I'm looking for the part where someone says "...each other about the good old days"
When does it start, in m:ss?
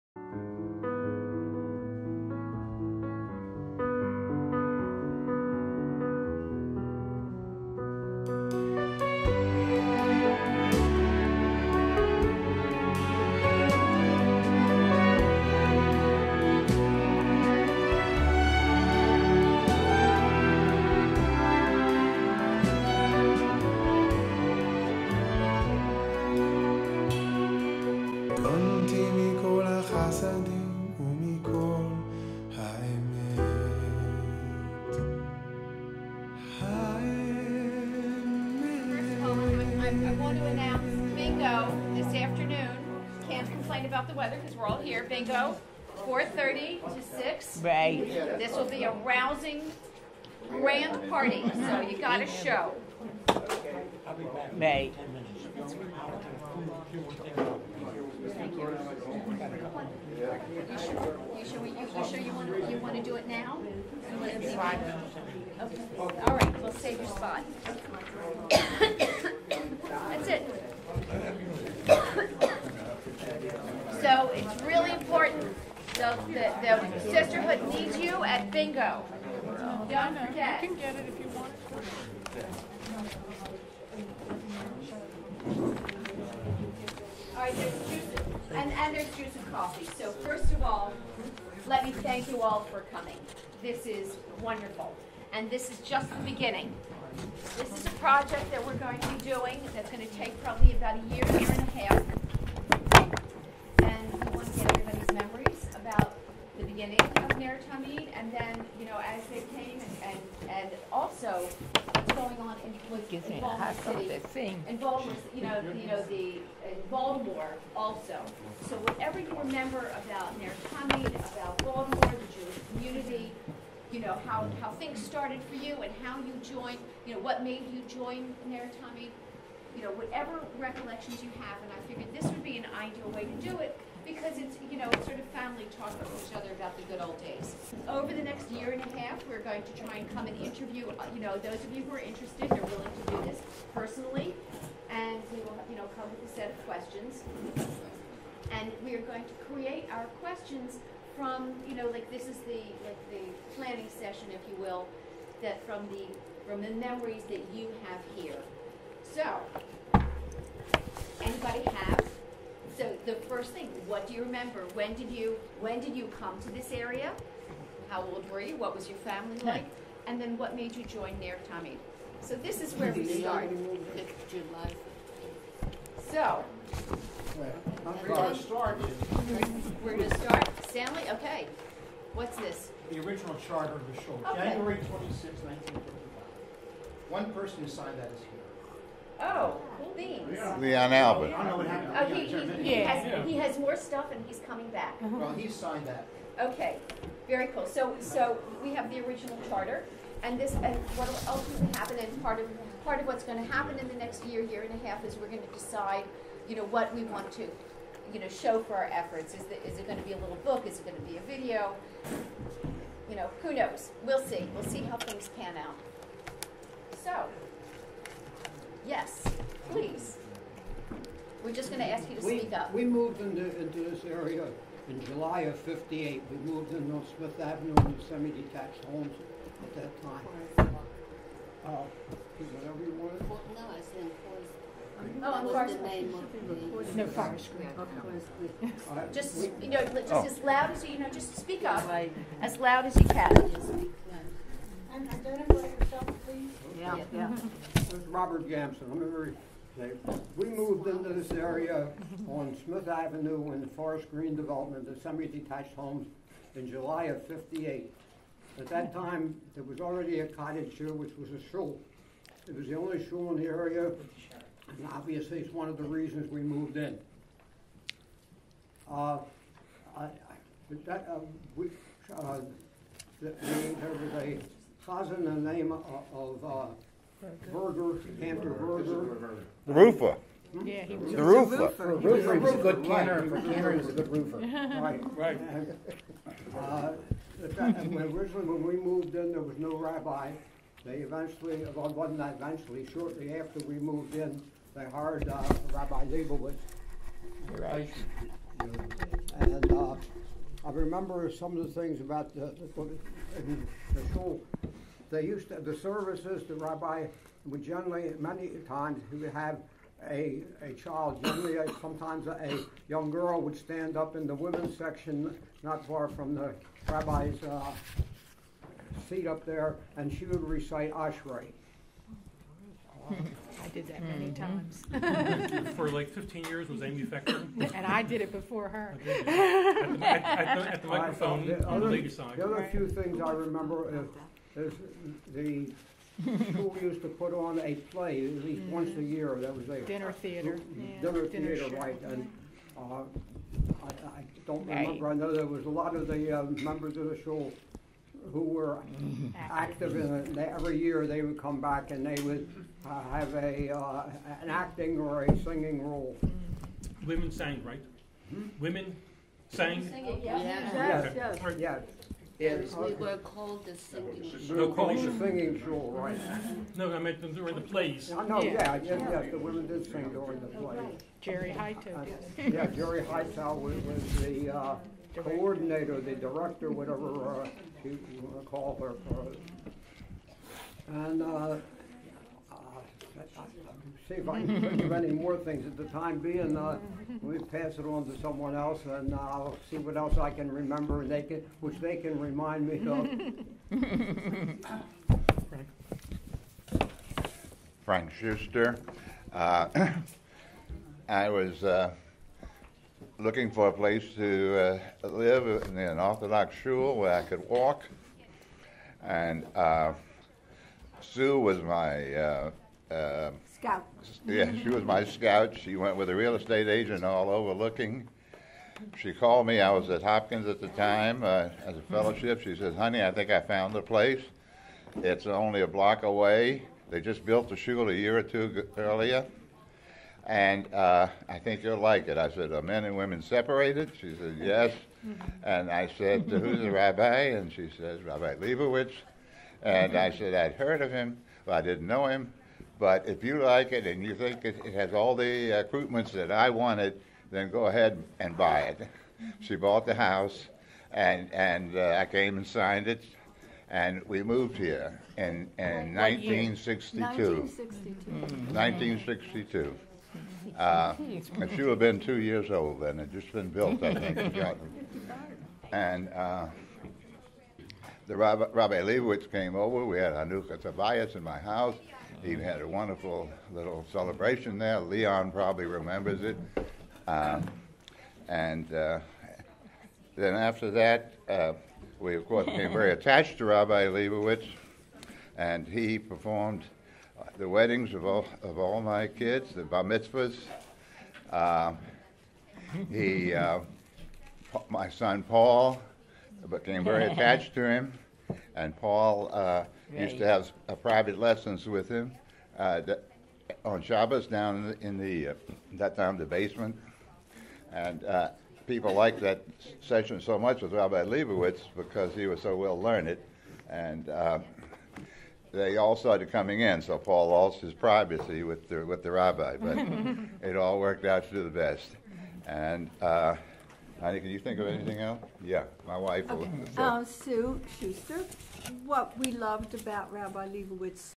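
2:16.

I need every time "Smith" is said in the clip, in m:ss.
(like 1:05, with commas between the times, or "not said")
3:47, 4:12.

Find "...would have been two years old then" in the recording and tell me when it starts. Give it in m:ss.
7:41.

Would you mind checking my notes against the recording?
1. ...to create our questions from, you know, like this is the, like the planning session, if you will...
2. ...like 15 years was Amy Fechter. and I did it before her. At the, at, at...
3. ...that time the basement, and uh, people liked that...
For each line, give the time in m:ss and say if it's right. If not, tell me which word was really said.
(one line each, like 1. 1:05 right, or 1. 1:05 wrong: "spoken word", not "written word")
1. 2:29 right
2. 5:25 right
3. 8:25 right.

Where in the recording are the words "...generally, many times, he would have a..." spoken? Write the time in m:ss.
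5:07.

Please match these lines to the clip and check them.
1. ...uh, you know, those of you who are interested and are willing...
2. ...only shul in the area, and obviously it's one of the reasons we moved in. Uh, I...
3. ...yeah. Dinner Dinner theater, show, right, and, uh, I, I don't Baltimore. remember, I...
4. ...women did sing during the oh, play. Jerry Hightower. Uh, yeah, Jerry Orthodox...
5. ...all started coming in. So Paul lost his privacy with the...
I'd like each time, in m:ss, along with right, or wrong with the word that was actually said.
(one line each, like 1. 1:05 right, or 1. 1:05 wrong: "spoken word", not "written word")
1. 2:20 right
2. 4:22 right
3. 5:40 wrong: "Right", not "Baltimore"
4. 6:09 wrong: "Hightower", not "Orthodox"
5. 8:35 right.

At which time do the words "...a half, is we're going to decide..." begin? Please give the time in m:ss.
3:24.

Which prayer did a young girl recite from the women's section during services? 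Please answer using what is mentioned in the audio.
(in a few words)
Ashrei.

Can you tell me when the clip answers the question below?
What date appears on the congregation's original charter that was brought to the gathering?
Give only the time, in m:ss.
3:04.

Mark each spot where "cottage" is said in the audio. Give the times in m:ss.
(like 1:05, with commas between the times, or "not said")
4:20.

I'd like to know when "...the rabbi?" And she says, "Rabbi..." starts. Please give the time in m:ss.
7:16.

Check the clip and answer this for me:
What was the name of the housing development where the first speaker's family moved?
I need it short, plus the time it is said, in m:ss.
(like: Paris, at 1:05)
Forest Green, at 4:13.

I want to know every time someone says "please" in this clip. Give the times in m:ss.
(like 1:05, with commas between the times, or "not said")
3:39, 4:06.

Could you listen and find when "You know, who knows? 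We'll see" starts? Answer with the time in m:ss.
3:33.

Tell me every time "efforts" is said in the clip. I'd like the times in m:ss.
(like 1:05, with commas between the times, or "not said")
3:28.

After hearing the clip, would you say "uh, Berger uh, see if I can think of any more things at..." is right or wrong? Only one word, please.
wrong.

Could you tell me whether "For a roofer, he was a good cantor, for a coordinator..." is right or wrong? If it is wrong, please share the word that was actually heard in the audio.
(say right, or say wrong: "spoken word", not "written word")
wrong: "cantor", not "coordinator".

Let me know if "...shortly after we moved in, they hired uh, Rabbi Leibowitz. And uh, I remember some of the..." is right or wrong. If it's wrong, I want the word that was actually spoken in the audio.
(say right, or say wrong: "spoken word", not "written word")
right.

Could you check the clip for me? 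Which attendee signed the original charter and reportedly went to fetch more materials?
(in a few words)
Leon Albert.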